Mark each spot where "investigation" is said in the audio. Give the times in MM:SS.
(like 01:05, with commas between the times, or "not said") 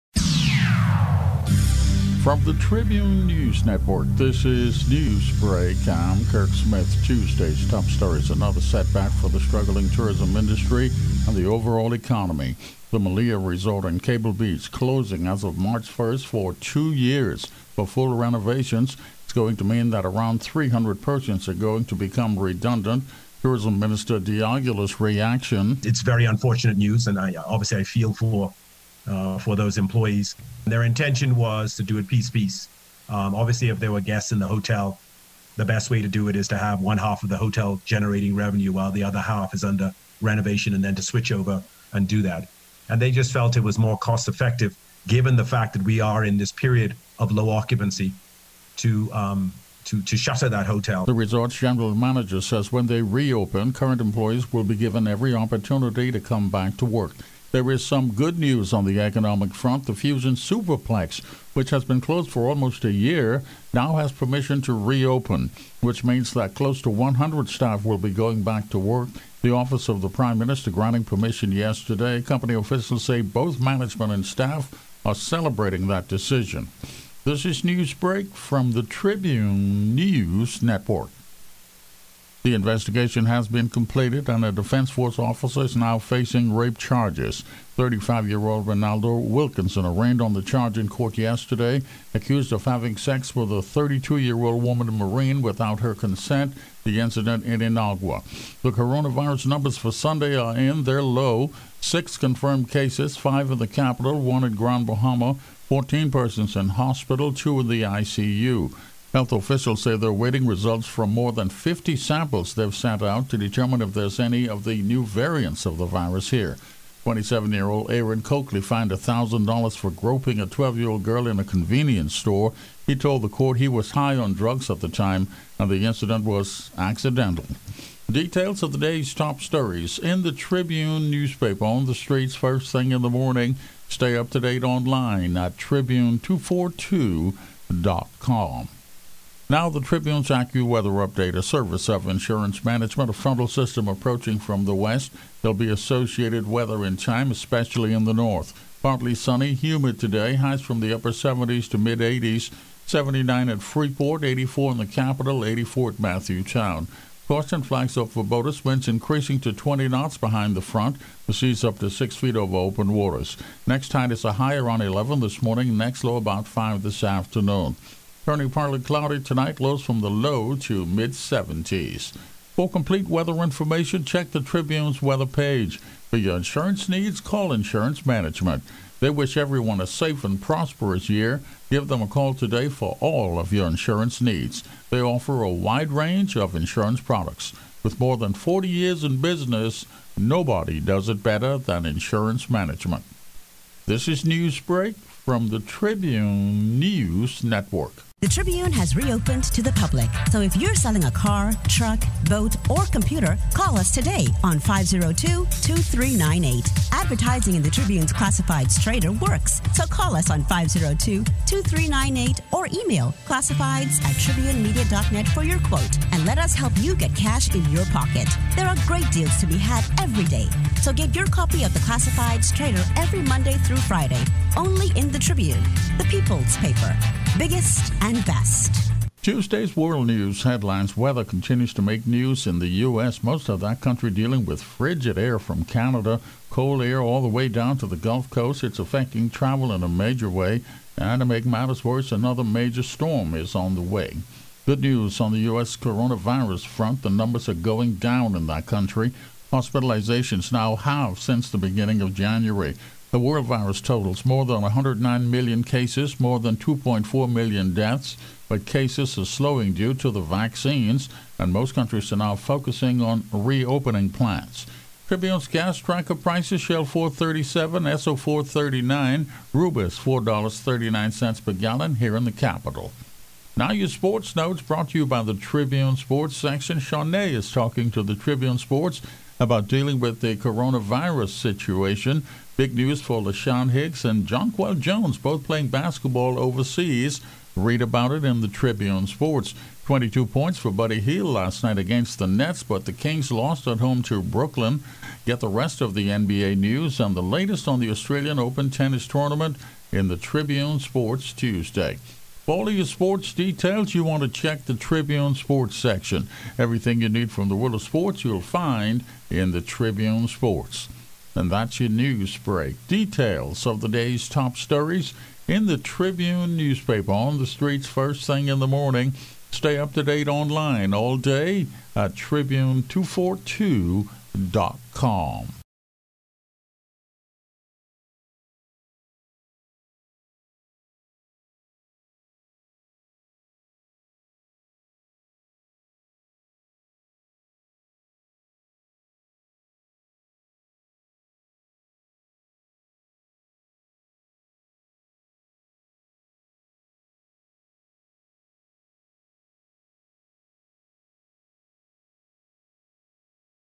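01:22.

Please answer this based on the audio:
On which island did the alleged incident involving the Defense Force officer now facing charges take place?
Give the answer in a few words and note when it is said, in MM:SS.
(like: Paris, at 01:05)
Inagua, at 01:37.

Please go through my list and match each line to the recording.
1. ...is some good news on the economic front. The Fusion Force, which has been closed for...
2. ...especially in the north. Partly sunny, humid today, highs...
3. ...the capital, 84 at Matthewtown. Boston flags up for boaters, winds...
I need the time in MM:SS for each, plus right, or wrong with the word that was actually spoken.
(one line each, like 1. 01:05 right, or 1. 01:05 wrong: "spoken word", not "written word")
1. 00:57 wrong: "Superplex", not "Force"
2. 02:27 right
3. 02:34 right.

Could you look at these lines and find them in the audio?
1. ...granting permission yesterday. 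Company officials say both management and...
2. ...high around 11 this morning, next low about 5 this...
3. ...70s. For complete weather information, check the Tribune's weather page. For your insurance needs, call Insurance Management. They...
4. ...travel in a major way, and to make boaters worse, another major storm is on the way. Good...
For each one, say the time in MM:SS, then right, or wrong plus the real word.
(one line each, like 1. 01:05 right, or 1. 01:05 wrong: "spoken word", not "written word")
1. 01:10 right
2. 02:44 right
3. 02:51 right
4. 03:59 wrong: "matters", not "boaters".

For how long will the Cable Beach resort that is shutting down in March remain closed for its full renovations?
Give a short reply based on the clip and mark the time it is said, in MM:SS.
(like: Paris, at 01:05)
2 years, at 00:16.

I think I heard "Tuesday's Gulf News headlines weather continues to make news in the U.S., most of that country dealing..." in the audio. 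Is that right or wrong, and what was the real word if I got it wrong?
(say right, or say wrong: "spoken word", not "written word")
wrong: "World", not "Gulf".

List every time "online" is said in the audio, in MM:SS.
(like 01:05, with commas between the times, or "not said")
02:14, 05:20.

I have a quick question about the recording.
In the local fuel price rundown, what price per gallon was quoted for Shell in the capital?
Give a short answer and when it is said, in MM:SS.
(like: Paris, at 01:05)
$4.37, at 04:26.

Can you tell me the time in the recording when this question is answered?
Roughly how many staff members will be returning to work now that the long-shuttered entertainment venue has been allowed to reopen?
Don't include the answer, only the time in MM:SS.
01:06.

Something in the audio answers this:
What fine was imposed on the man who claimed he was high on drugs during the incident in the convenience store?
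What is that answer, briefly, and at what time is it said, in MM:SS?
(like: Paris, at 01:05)
$1,000, at 01:58.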